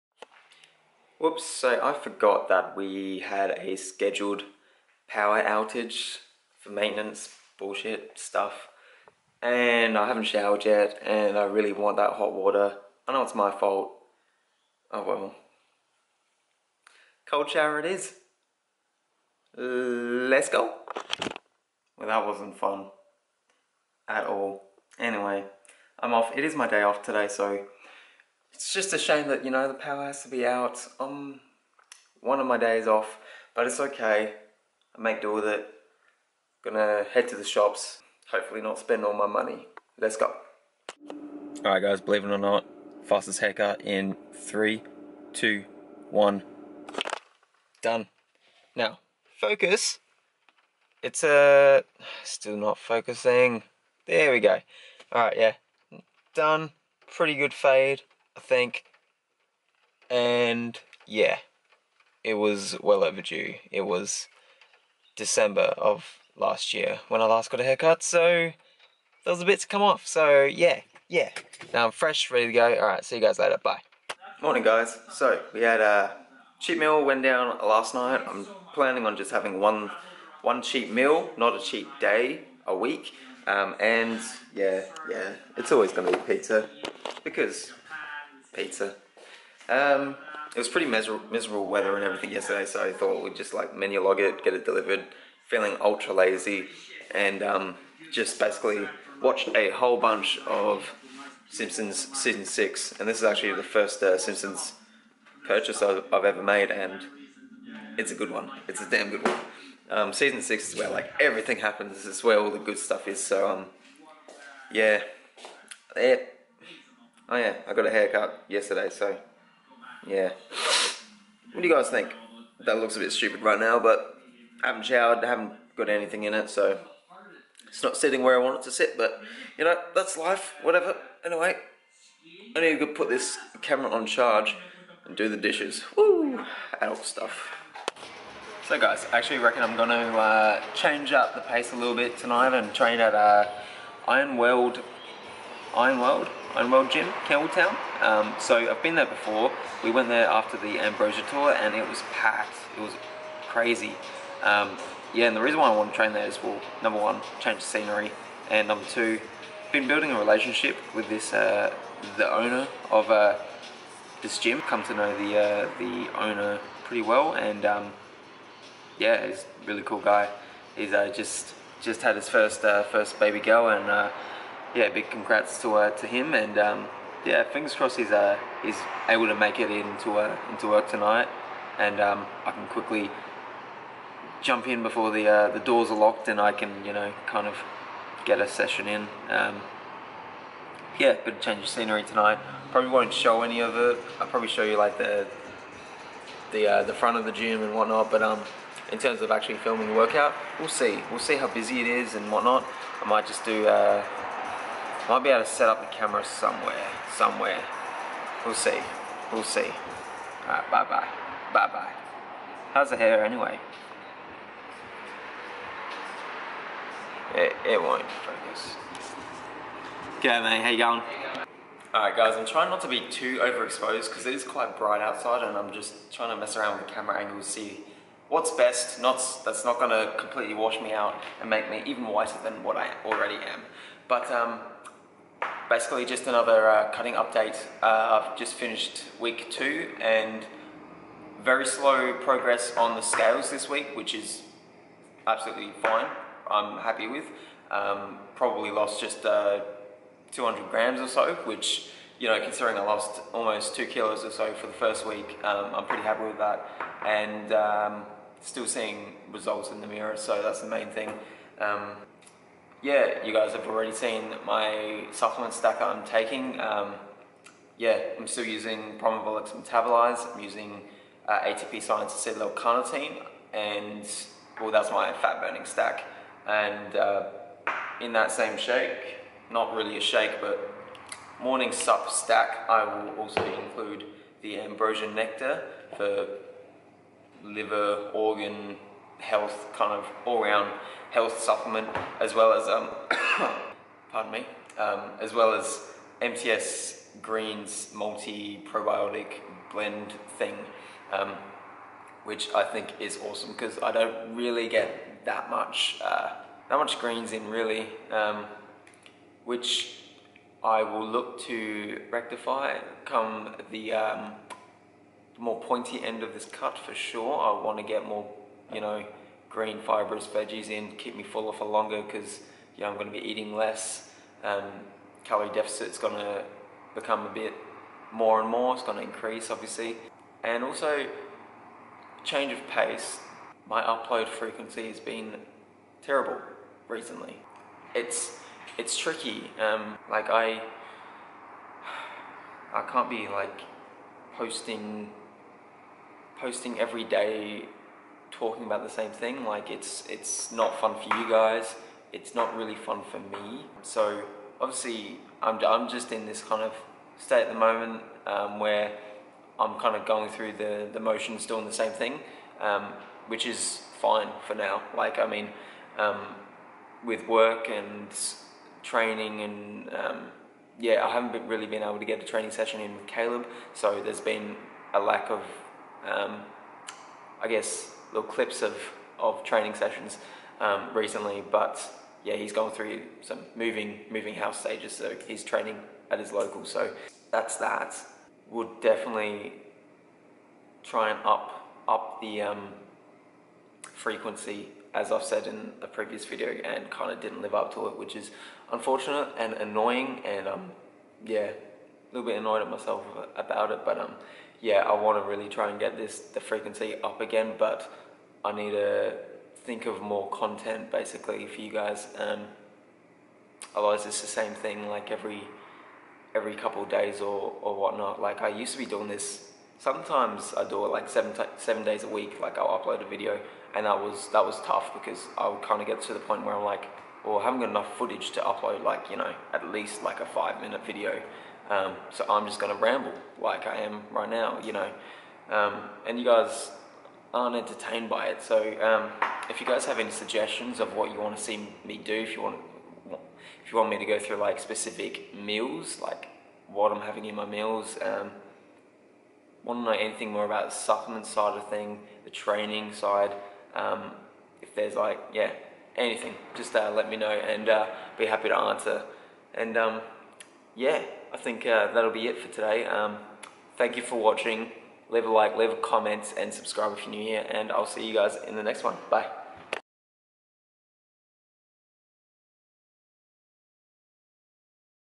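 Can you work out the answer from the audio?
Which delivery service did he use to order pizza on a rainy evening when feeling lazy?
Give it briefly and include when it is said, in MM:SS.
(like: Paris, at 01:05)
Menulog, at 01:33.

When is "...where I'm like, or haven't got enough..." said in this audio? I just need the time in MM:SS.
07:06.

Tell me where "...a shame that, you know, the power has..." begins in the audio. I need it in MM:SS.
00:28.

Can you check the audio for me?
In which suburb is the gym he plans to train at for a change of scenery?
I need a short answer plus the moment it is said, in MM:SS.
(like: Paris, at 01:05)
Campbelltown, at 02:27.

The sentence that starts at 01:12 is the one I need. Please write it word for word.
All right, see you guys later.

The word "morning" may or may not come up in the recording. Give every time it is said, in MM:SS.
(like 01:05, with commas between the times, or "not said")
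01:14, 04:41.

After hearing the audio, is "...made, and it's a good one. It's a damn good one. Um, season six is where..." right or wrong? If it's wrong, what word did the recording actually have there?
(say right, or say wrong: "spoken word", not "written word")
right.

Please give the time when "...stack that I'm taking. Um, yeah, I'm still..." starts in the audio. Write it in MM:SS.
04:25.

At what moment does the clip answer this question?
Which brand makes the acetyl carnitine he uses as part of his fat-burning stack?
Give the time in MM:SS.
04:31.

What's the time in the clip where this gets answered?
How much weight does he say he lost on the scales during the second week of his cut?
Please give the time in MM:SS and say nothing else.
04:10.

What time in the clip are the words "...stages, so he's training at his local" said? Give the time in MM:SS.
06:24.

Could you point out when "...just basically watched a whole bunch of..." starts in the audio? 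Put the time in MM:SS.
01:38.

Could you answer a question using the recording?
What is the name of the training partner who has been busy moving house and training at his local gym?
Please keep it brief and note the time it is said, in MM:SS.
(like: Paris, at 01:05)
Caleb, at 06:13.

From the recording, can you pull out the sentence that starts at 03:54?
But um, basically just another uh, cutting update.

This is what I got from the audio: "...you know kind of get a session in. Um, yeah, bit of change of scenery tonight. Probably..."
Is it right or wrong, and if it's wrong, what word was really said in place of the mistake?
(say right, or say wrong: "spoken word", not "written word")
right.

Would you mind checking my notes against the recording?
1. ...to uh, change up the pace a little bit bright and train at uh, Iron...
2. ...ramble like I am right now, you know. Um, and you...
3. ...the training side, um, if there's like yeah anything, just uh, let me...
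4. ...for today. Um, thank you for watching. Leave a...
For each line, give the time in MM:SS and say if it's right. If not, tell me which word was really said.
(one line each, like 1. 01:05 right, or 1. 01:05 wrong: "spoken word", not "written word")
1. 02:19 wrong: "tonight", not "bright"
2. 07:12 right
3. 07:32 right
4. 07:42 right.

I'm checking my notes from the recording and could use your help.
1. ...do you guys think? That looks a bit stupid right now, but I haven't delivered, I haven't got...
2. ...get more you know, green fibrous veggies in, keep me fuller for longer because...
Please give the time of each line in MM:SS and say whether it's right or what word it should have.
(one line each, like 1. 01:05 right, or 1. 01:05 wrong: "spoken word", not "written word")
1. 02:01 wrong: "showered", not "delivered"
2. 05:17 right.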